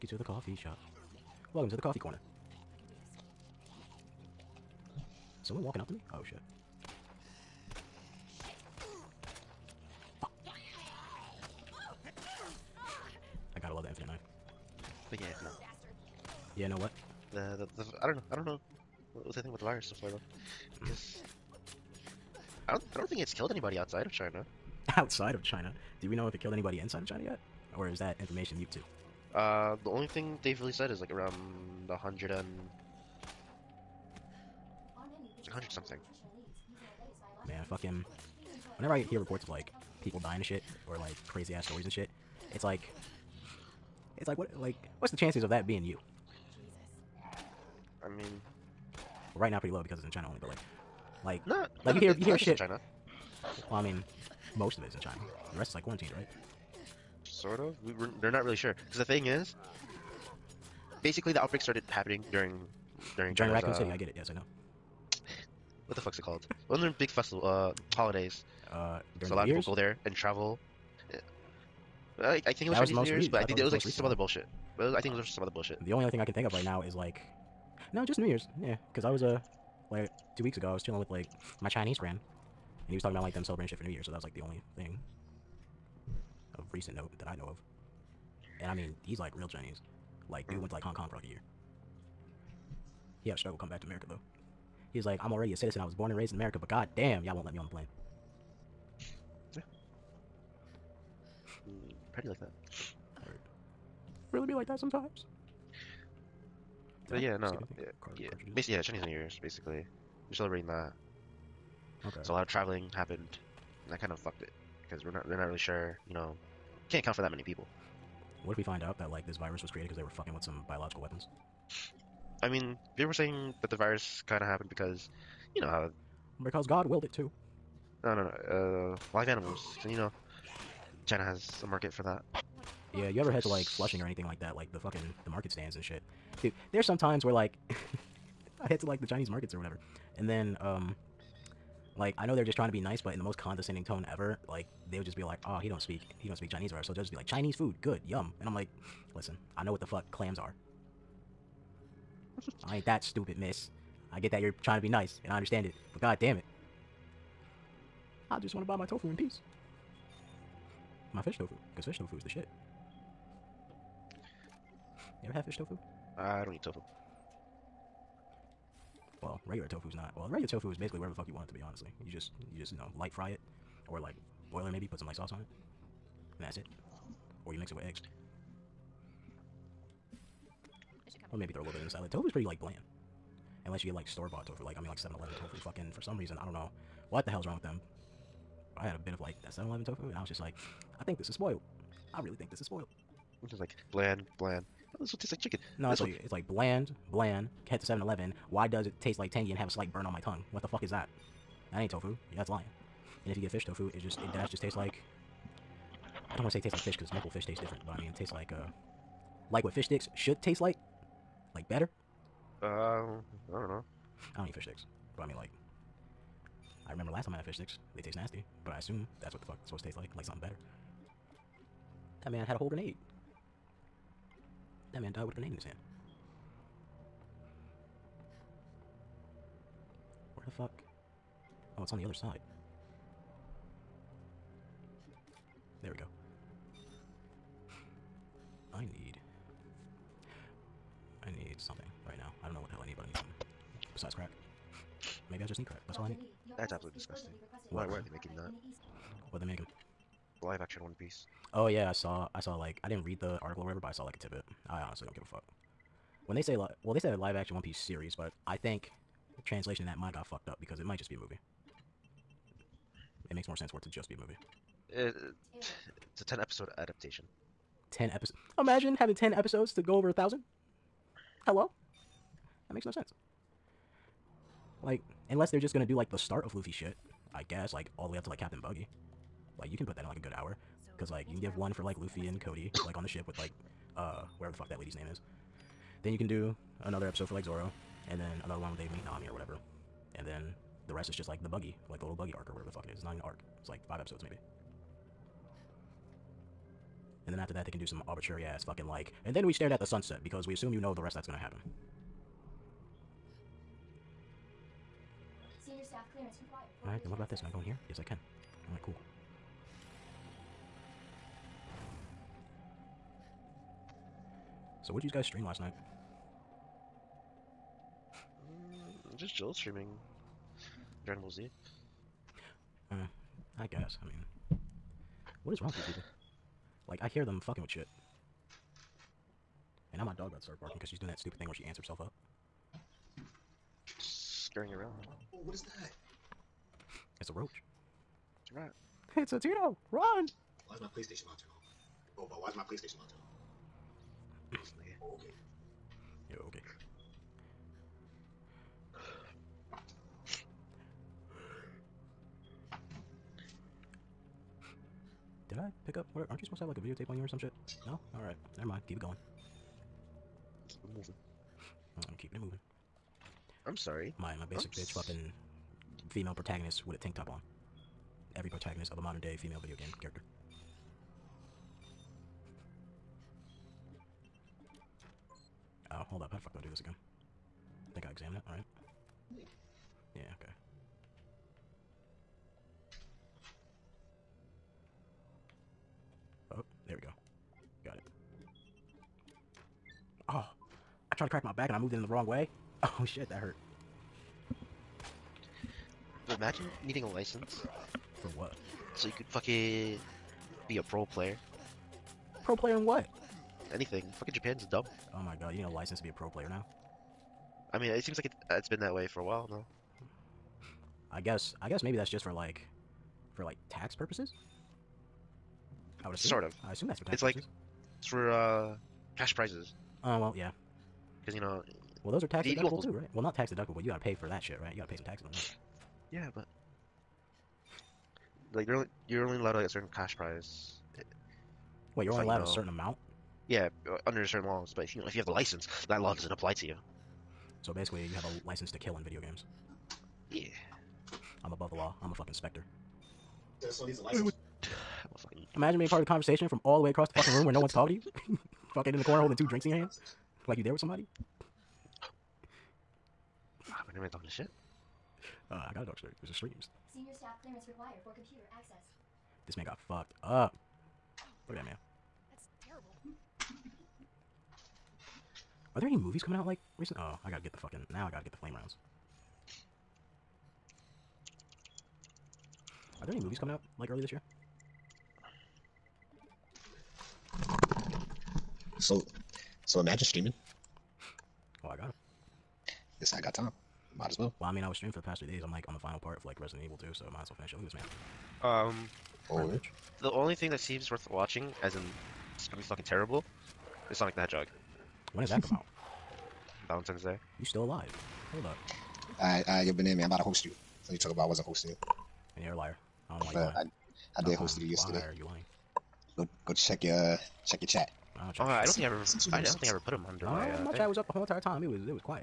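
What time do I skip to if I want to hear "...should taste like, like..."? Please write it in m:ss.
3:30.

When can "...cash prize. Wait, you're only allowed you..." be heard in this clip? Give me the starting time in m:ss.
7:09.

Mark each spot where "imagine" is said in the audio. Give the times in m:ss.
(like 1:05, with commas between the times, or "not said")
4:28, 6:36, 7:25, 7:59.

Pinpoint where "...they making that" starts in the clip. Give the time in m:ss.
4:08.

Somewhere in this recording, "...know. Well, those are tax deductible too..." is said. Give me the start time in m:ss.
7:01.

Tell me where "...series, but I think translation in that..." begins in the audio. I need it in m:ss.
4:17.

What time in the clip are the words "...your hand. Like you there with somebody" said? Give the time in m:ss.
7:29.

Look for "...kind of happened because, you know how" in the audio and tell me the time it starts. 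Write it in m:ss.
2:04.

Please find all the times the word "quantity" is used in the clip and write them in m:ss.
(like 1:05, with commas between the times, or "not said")
not said.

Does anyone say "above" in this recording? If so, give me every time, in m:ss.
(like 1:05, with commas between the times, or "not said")
7:21.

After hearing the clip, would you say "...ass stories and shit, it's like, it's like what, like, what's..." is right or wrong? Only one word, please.
right.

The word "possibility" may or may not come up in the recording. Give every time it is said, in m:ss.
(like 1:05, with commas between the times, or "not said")
not said.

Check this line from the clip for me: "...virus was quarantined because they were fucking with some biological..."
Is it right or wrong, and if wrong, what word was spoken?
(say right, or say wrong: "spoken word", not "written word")
wrong: "created", not "quarantined".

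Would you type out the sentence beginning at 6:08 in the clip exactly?
Every protagonist of a modern day female video game character.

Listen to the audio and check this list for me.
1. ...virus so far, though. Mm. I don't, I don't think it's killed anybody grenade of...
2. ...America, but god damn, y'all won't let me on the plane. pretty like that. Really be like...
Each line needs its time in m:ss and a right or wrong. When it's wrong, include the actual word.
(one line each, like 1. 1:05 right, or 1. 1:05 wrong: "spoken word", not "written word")
1. 0:19 wrong: "outside", not "grenade"
2. 1:36 right.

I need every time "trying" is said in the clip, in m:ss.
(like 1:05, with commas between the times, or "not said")
2:22, 2:34.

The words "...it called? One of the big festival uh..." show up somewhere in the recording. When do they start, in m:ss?
1:06.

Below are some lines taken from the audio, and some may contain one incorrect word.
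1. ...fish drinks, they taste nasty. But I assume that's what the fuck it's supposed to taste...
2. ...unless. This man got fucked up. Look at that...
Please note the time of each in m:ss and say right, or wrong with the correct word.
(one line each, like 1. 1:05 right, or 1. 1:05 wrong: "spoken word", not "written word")
1. 3:37 wrong: "sticks", not "drinks"
2. 7:38 wrong: "access", not "unless".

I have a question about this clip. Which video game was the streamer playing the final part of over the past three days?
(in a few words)
Resident Evil 2.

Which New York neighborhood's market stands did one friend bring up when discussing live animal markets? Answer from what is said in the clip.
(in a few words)
Flushing.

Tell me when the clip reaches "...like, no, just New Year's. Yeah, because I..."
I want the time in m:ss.
1:16.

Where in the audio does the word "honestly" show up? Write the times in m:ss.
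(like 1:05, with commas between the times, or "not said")
2:51, 4:14.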